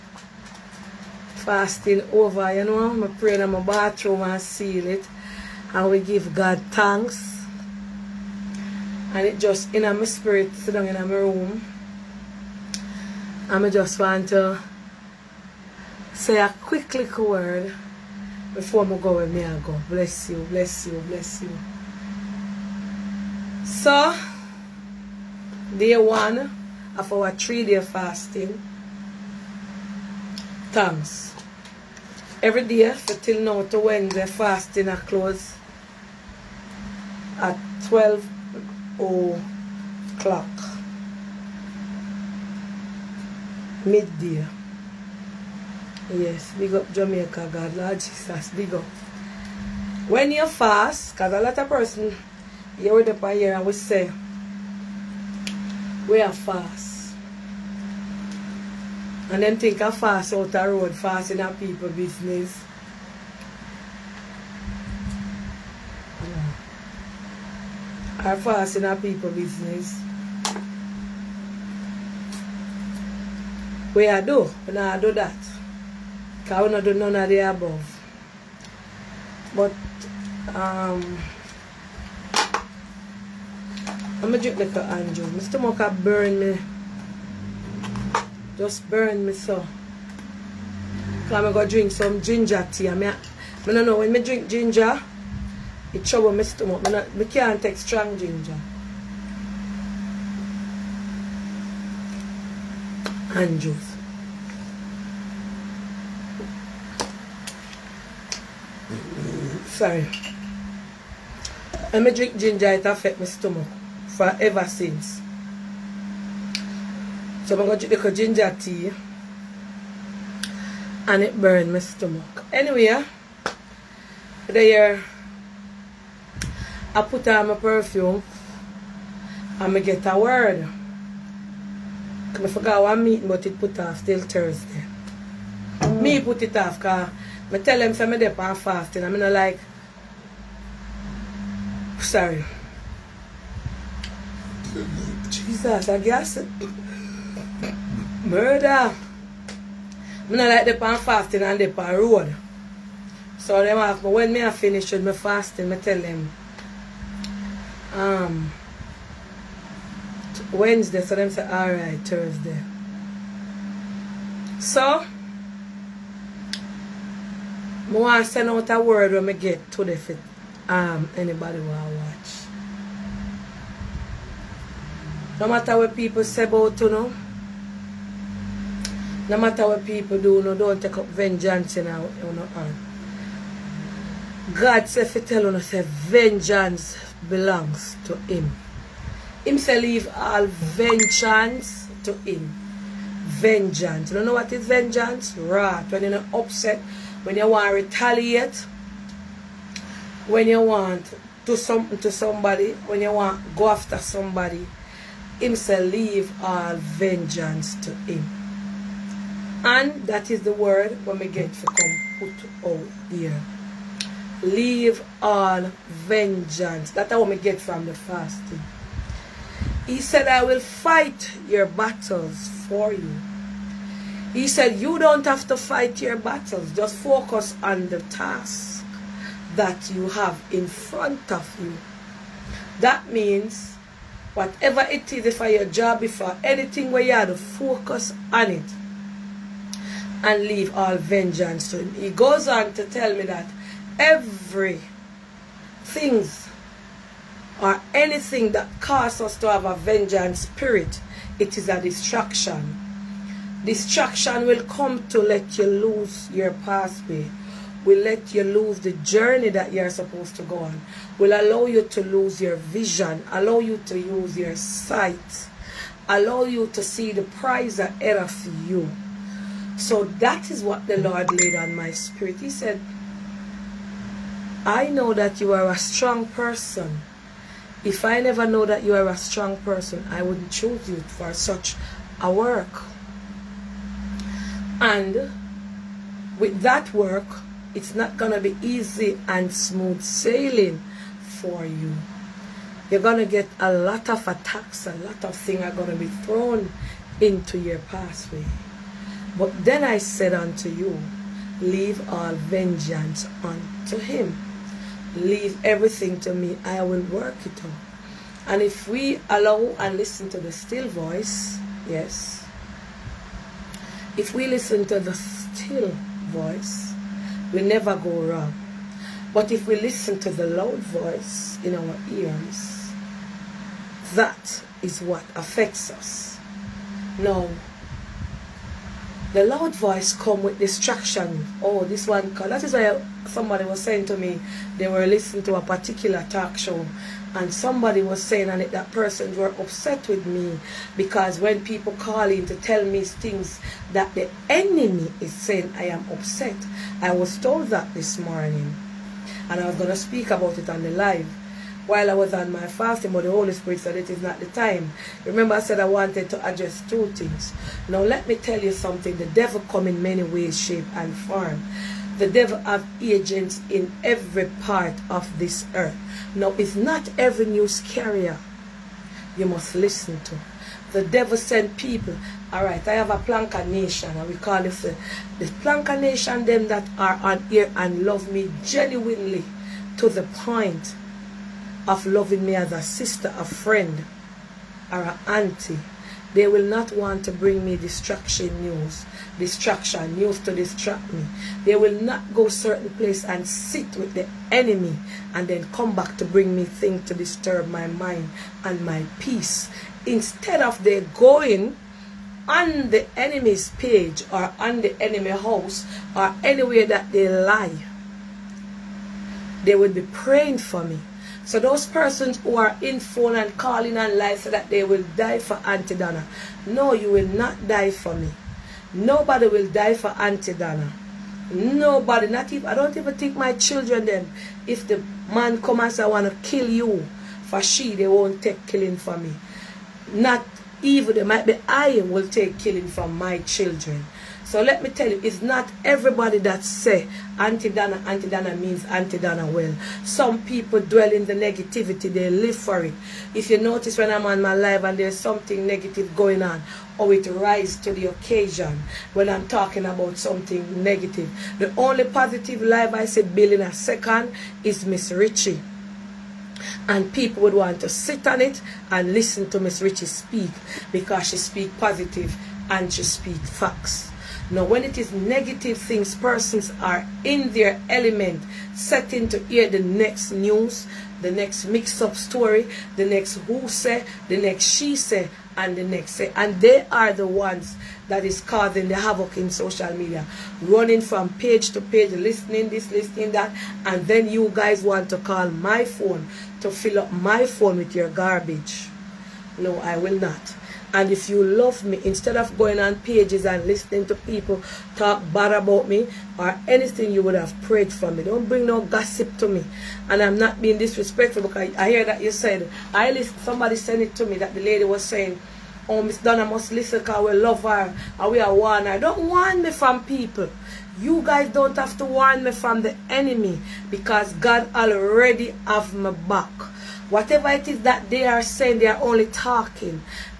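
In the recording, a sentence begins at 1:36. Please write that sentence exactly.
I, I can't take strong ginger.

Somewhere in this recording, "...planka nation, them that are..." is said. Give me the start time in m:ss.
6:15.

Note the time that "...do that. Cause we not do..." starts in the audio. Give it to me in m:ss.
1:14.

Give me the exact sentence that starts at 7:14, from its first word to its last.
So let me tell you, it's not everybody that say Auntie Dana, Auntie Dana means Auntie Dana well.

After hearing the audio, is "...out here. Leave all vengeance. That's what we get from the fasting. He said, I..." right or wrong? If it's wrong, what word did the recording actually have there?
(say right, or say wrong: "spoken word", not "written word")
right.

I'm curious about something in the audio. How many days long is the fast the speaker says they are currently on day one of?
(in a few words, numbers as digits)
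3.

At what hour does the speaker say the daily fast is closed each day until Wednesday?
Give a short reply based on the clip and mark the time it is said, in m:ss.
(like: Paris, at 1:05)
12 o'clock, at 0:37.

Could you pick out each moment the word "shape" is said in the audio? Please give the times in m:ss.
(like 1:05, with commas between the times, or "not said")
6:00.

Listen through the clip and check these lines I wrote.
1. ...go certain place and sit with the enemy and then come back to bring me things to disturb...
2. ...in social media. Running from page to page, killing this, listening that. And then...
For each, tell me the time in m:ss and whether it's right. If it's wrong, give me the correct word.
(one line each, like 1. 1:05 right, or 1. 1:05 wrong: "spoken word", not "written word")
1. 6:32 right
2. 7:59 wrong: "listening", not "killing".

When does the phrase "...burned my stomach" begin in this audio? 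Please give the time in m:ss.
2:01.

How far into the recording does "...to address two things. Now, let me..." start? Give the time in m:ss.
5:56.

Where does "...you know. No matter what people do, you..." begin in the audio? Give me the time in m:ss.
2:56.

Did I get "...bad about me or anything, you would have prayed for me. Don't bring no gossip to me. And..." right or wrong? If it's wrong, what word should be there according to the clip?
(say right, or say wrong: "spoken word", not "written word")
right.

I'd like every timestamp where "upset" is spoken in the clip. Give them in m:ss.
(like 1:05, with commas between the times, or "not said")
3:16, 5:39, 5:46.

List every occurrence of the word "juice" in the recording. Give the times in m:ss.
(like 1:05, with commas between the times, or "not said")
1:43.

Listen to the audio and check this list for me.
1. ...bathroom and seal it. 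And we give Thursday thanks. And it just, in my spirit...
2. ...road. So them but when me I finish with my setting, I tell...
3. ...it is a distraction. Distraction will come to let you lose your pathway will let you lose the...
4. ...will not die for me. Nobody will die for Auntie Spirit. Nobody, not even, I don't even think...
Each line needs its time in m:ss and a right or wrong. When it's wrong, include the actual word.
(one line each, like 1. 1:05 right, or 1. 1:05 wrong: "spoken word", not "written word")
1. 0:03 wrong: "God", not "Thursday"
2. 2:31 wrong: "fasting", not "setting"
3. 4:11 right
4. 6:57 wrong: "Donna", not "Spirit".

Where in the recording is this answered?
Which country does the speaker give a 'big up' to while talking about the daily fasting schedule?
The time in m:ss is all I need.
0:46.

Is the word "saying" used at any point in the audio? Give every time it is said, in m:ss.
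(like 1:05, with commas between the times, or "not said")
5:33, 5:38, 5:45, 8:25, 8:38.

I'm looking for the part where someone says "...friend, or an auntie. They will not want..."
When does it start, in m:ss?
6:23.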